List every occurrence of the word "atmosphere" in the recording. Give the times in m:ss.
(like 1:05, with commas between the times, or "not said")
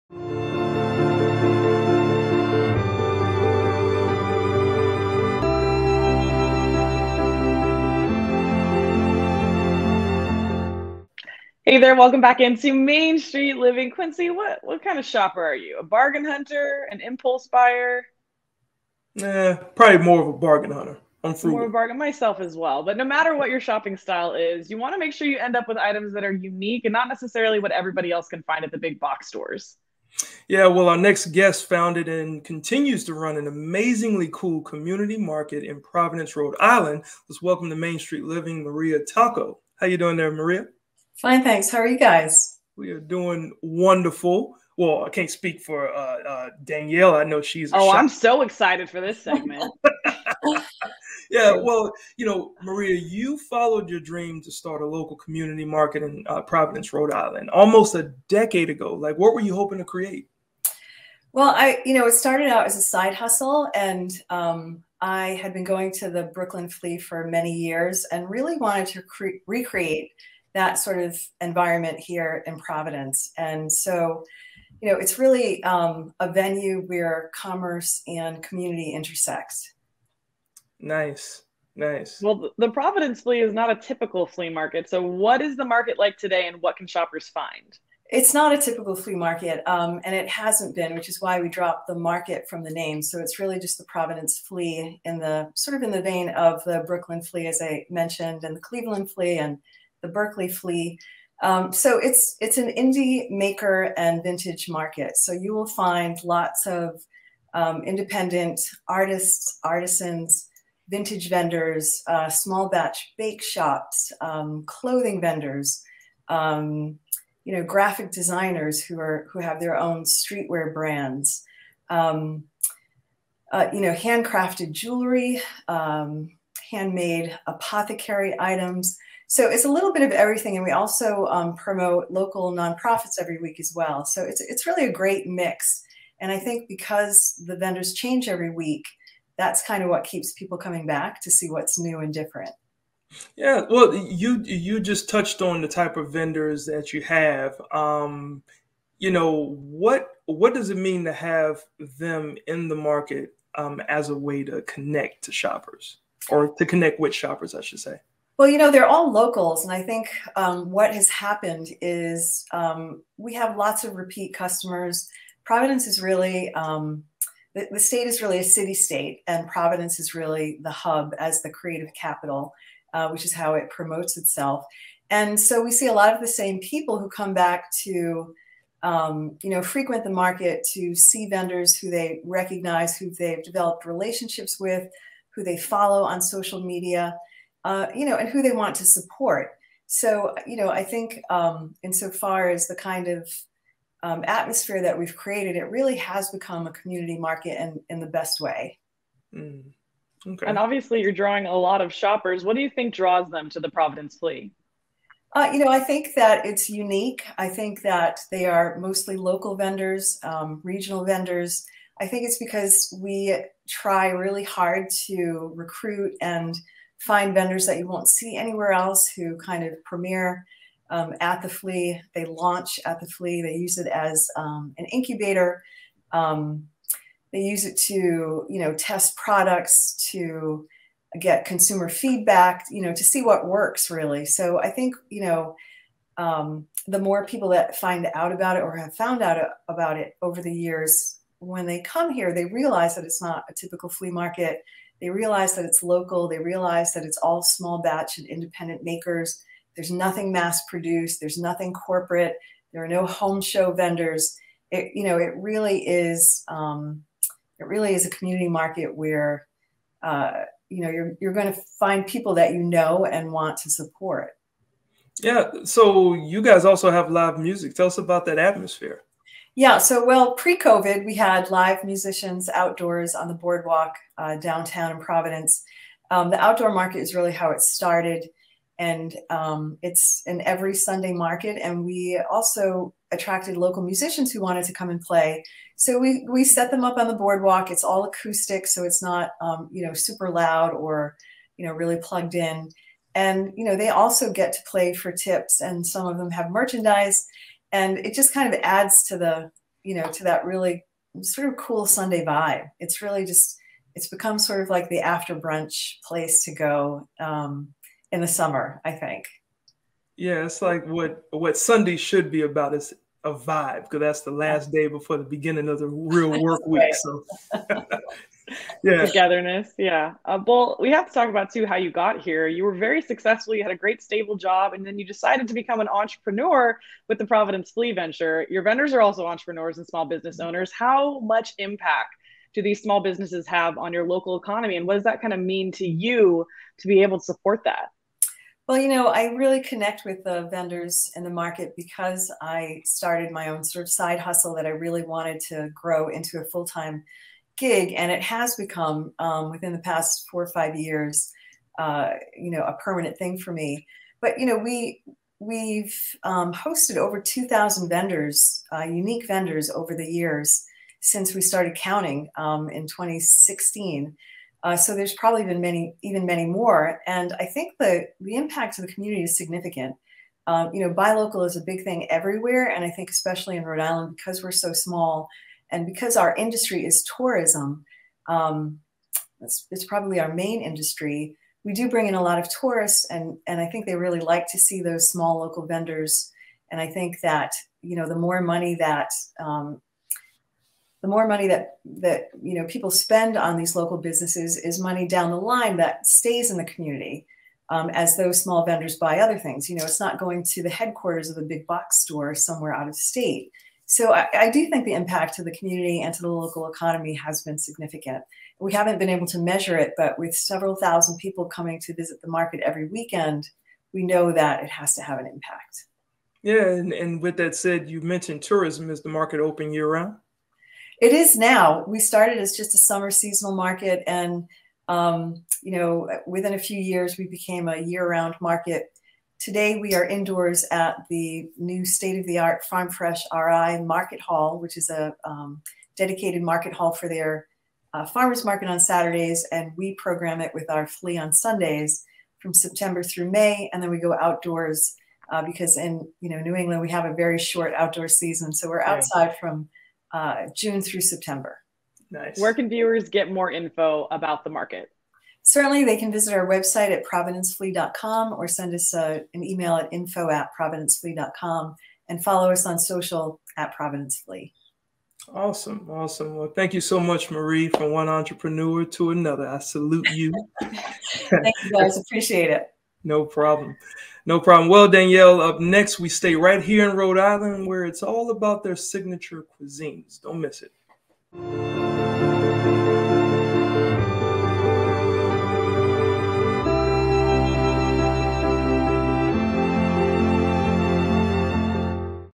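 3:14, 4:28.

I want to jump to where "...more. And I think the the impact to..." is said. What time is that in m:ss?
6:06.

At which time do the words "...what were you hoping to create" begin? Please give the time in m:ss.
0:59.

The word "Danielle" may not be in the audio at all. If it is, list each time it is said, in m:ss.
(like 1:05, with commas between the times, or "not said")
0:46, 7:54.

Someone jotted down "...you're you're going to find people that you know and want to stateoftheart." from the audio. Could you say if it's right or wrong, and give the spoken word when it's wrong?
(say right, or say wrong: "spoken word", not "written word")
wrong: "support", not "stateoftheart".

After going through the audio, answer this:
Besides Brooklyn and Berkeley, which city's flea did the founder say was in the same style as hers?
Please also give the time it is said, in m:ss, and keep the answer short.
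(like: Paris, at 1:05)
Cleveland, at 1:38.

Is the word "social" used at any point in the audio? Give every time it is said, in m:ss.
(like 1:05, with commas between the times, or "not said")
3:06, 7:42.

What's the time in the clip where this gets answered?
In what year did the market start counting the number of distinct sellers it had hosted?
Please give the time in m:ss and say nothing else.
6:02.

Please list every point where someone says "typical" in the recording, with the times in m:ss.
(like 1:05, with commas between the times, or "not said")
1:23, 1:28, 4:03.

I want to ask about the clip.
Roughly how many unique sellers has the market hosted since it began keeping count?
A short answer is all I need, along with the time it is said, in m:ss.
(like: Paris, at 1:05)
2,000, at 5:57.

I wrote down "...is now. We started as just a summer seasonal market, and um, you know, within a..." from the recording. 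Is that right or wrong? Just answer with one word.
right.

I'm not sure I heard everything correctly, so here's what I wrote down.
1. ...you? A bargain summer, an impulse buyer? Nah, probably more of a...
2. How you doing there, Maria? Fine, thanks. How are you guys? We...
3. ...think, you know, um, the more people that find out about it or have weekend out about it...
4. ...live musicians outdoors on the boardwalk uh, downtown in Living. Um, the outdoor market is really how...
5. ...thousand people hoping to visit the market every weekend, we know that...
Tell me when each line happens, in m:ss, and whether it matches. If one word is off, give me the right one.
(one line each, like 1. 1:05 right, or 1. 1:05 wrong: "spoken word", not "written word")
1. 0:15 wrong: "hunter", not "summer"
2. 0:39 right
3. 3:54 wrong: "found", not "weekend"
4. 4:31 wrong: "Providence", not "Living"
5. 6:50 wrong: "coming", not "hoping".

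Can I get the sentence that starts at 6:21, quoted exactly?
We do bring in a lot of tourists, and and I think they really like to see those small local vendors.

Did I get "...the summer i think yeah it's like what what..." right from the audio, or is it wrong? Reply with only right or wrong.
right.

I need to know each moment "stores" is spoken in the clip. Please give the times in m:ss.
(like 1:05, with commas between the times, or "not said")
0:29, 6:42.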